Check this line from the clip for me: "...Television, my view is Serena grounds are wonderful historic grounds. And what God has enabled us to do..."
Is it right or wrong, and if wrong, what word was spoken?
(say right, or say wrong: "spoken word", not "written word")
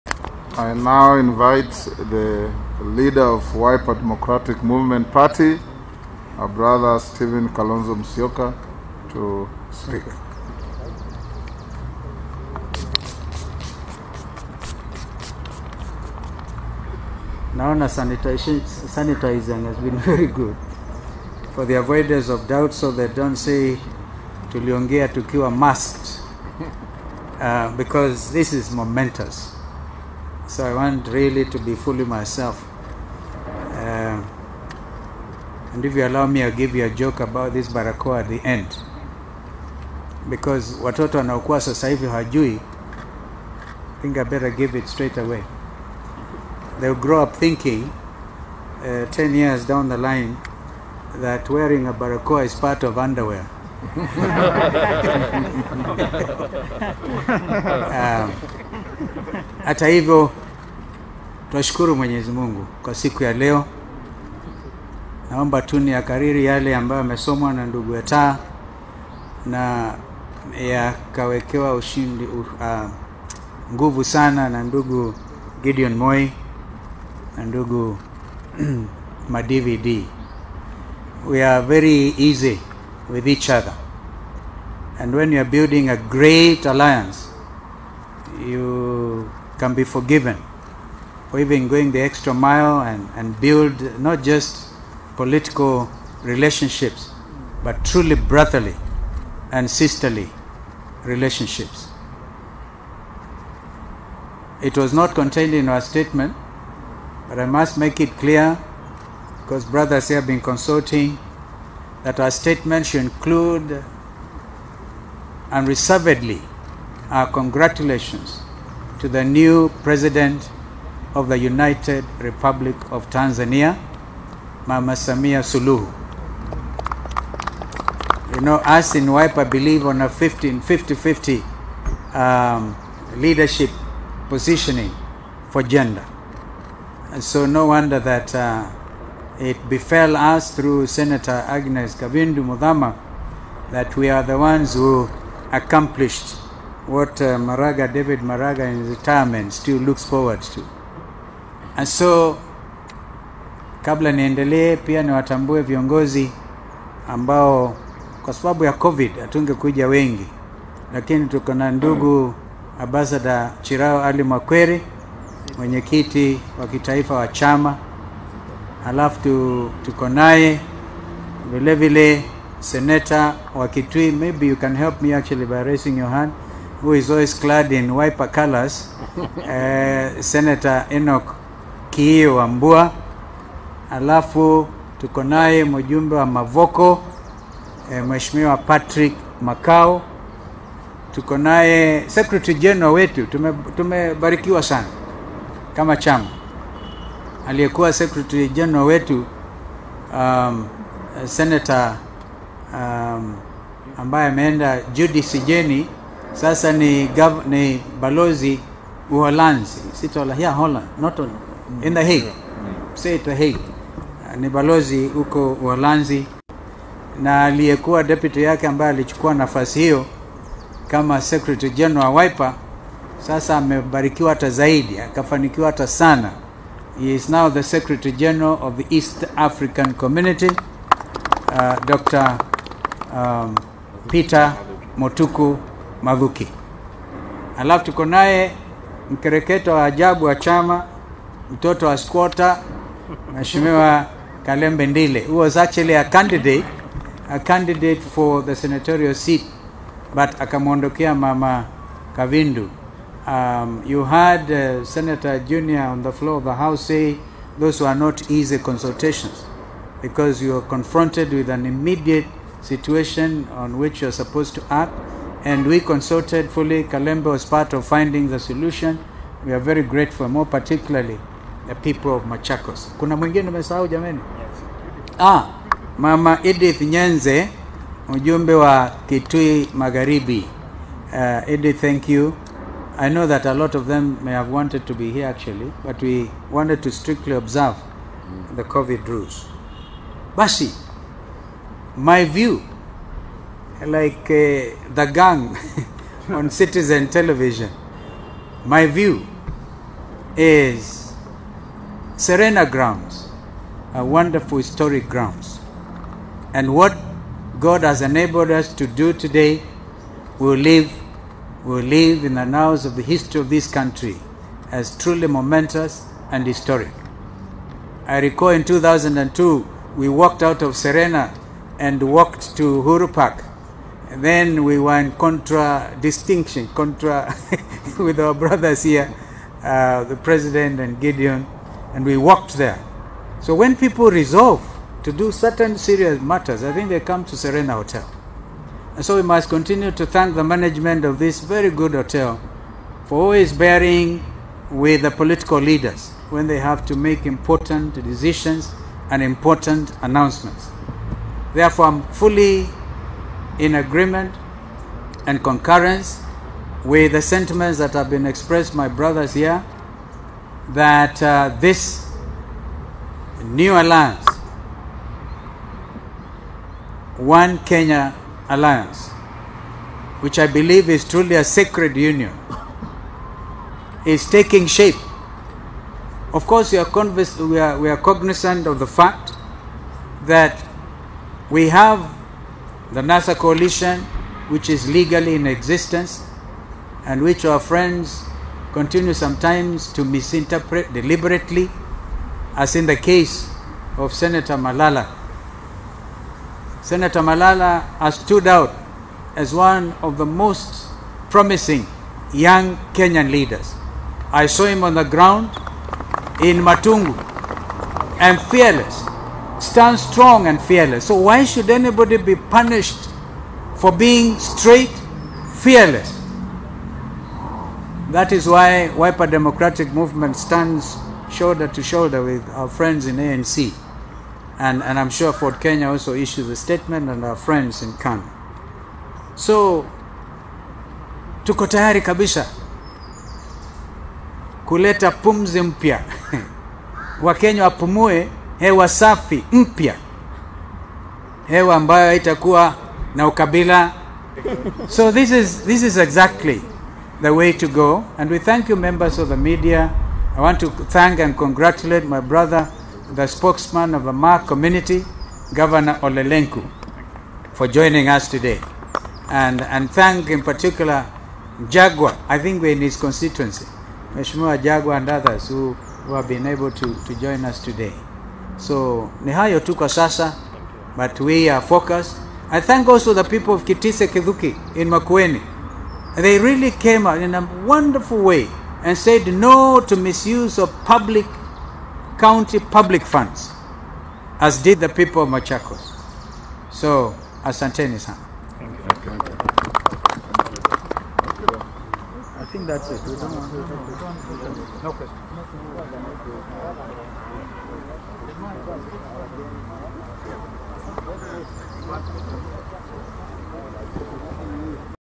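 right.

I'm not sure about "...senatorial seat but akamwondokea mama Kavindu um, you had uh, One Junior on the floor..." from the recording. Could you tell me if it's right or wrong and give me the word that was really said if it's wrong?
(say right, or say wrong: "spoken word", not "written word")
wrong: "Senator", not "One".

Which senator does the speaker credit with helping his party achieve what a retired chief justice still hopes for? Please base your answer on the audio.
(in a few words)
Agnes Kavindu Muthama.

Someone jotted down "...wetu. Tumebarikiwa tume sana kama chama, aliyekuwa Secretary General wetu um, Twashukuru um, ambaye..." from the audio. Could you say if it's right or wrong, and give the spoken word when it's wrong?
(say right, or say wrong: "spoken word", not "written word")
wrong: "Senator", not "Twashukuru".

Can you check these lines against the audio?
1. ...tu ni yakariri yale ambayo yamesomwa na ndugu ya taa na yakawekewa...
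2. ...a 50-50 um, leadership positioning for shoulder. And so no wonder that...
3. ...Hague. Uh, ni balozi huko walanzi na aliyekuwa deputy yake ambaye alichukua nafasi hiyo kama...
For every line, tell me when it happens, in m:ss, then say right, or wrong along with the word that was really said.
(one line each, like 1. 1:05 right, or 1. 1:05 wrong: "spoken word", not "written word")
1. 1:05 right
2. 2:10 wrong: "gender", not "shoulder"
3. 3:33 right.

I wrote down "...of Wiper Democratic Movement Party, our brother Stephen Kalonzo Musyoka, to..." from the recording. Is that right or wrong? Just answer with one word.
right.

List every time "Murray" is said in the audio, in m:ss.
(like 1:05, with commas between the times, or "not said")
not said.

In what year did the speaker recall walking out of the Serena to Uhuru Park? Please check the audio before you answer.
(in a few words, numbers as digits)
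2002.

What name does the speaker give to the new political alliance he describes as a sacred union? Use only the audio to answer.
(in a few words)
One Kenya Alliance.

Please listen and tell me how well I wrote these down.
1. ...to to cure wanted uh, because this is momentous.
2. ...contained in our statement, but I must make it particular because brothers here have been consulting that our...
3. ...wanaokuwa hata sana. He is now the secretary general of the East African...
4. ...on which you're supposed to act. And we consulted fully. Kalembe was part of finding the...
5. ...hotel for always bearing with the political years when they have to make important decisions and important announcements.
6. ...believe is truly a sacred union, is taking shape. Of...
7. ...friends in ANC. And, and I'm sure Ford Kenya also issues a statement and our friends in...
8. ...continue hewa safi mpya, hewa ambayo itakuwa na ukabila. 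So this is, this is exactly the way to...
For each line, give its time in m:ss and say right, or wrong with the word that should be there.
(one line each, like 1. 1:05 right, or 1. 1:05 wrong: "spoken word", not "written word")
1. 0:24 wrong: "masked", not "wanted"
2. 1:45 wrong: "clear", not "particular"
3. 3:44 wrong: "akafanikiwa", not "wanaokuwa"
4. 4:23 right
5. 5:41 wrong: "leaders", not "years"
6. 6:10 right
7. 7:02 right
8. 7:17 wrong: "wapumue", not "continue".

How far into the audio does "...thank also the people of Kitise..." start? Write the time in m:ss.
7:52.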